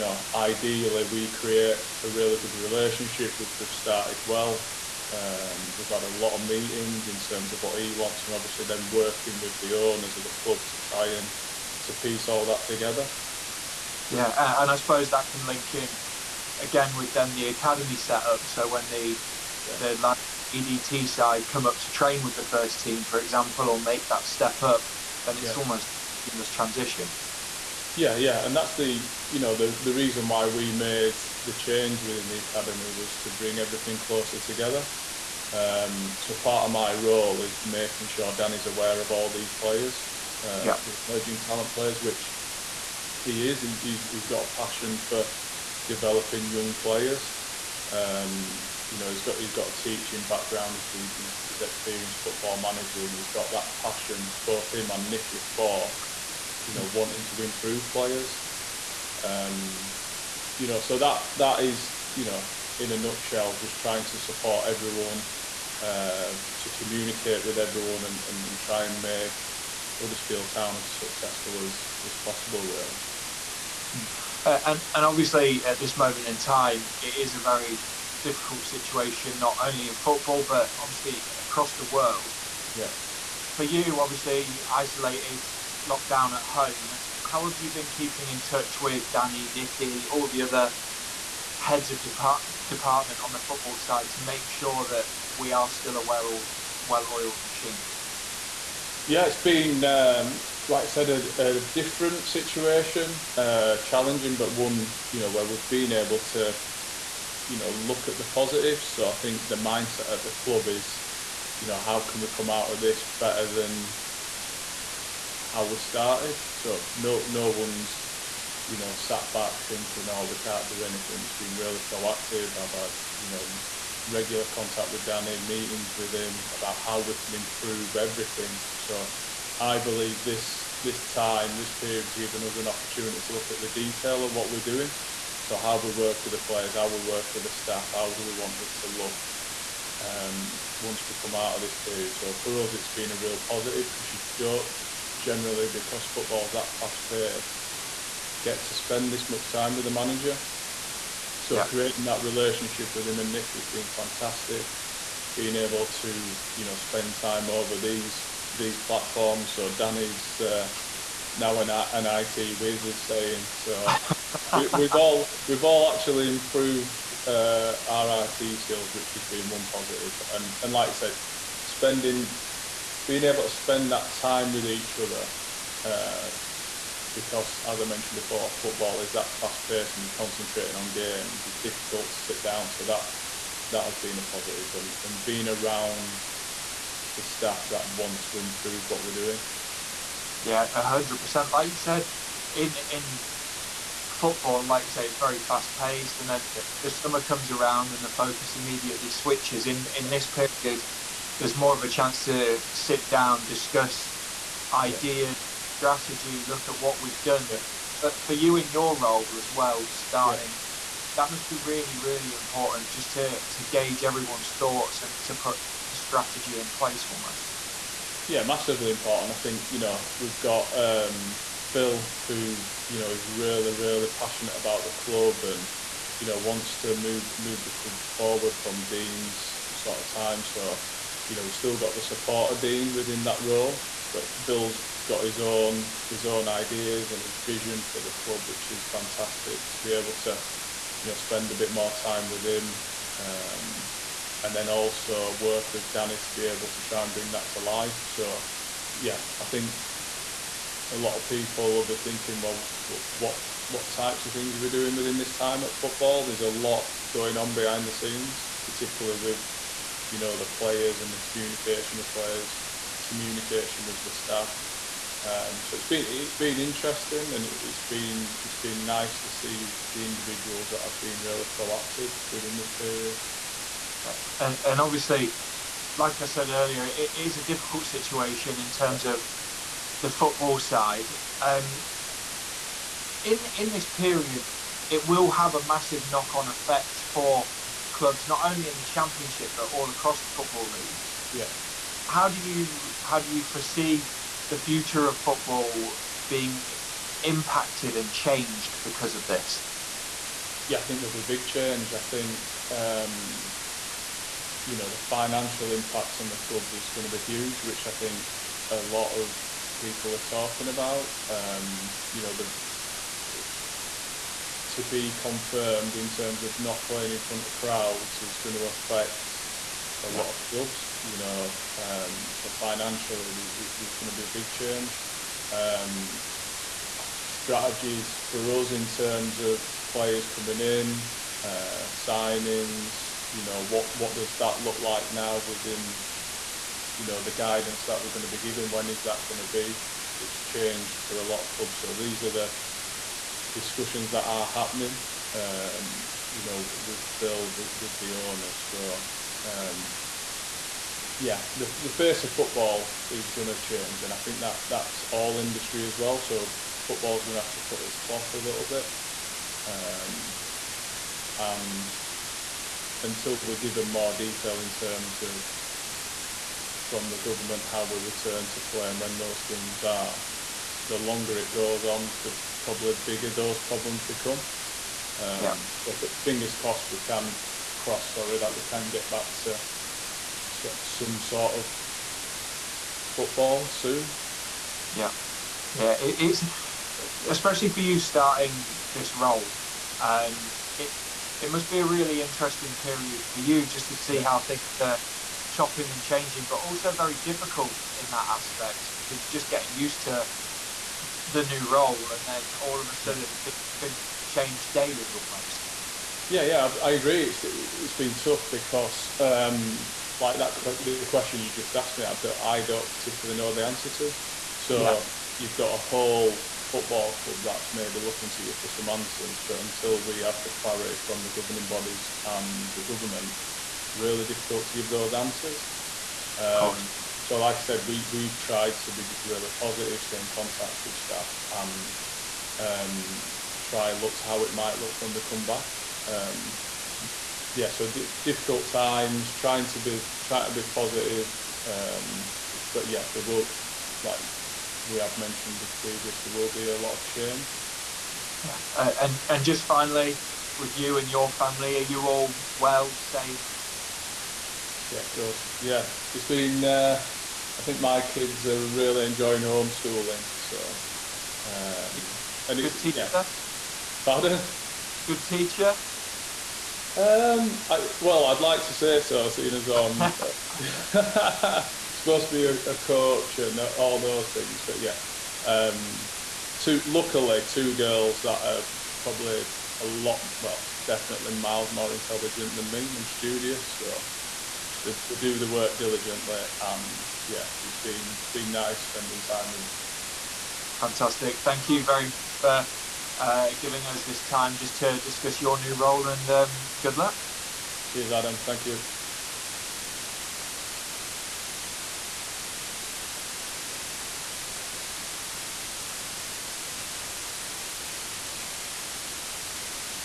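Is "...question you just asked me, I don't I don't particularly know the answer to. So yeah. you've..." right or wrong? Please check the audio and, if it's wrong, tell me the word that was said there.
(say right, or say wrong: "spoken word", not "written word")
right.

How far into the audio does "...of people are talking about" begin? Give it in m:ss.
5:09.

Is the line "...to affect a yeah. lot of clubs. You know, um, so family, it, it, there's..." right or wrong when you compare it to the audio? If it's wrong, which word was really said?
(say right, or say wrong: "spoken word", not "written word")
wrong: "financially", not "family".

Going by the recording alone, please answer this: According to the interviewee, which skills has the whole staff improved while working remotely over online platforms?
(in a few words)
IT skills.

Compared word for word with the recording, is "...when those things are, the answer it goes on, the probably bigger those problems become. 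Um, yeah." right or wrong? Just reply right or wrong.
wrong.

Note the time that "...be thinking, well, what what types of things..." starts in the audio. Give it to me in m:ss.
4:11.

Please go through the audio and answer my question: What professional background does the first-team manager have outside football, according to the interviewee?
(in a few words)
Teaching.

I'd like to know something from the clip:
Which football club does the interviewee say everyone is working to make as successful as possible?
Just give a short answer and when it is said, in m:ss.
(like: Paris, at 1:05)
Huddersfield Town, at 1:10.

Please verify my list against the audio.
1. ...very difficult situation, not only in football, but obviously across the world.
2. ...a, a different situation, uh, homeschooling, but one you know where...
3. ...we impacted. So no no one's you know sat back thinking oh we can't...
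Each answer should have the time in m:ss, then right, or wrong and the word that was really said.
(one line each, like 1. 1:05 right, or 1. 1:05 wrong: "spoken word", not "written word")
1. 1:17 right
2. 1:41 wrong: "challenging", not "homeschooling"
3. 1:55 wrong: "started", not "impacted".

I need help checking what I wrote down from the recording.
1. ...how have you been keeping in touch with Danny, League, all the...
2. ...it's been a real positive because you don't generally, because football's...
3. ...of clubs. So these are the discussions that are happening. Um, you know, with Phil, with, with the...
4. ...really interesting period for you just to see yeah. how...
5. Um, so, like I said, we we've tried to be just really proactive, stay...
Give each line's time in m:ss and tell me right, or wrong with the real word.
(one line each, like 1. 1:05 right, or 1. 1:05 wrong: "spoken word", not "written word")
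1. 1:27 wrong: "Nicky", not "League"
2. 2:22 right
3. 5:41 right
4. 6:31 right
5. 7:06 wrong: "positive", not "proactive".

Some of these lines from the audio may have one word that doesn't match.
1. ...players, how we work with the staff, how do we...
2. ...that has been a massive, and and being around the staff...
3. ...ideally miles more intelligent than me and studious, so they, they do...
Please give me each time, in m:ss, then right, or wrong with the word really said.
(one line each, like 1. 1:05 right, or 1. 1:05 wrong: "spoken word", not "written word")
1. 2:16 right
2. 3:03 wrong: "positive", not "massive"
3. 8:00 wrong: "definitely", not "ideally".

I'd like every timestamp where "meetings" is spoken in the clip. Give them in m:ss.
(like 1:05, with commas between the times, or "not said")
0:06, 2:05.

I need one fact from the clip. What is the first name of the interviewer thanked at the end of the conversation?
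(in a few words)
Adam.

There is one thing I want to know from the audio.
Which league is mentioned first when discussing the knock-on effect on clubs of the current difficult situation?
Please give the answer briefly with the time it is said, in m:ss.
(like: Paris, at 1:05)
Championship, at 4:48.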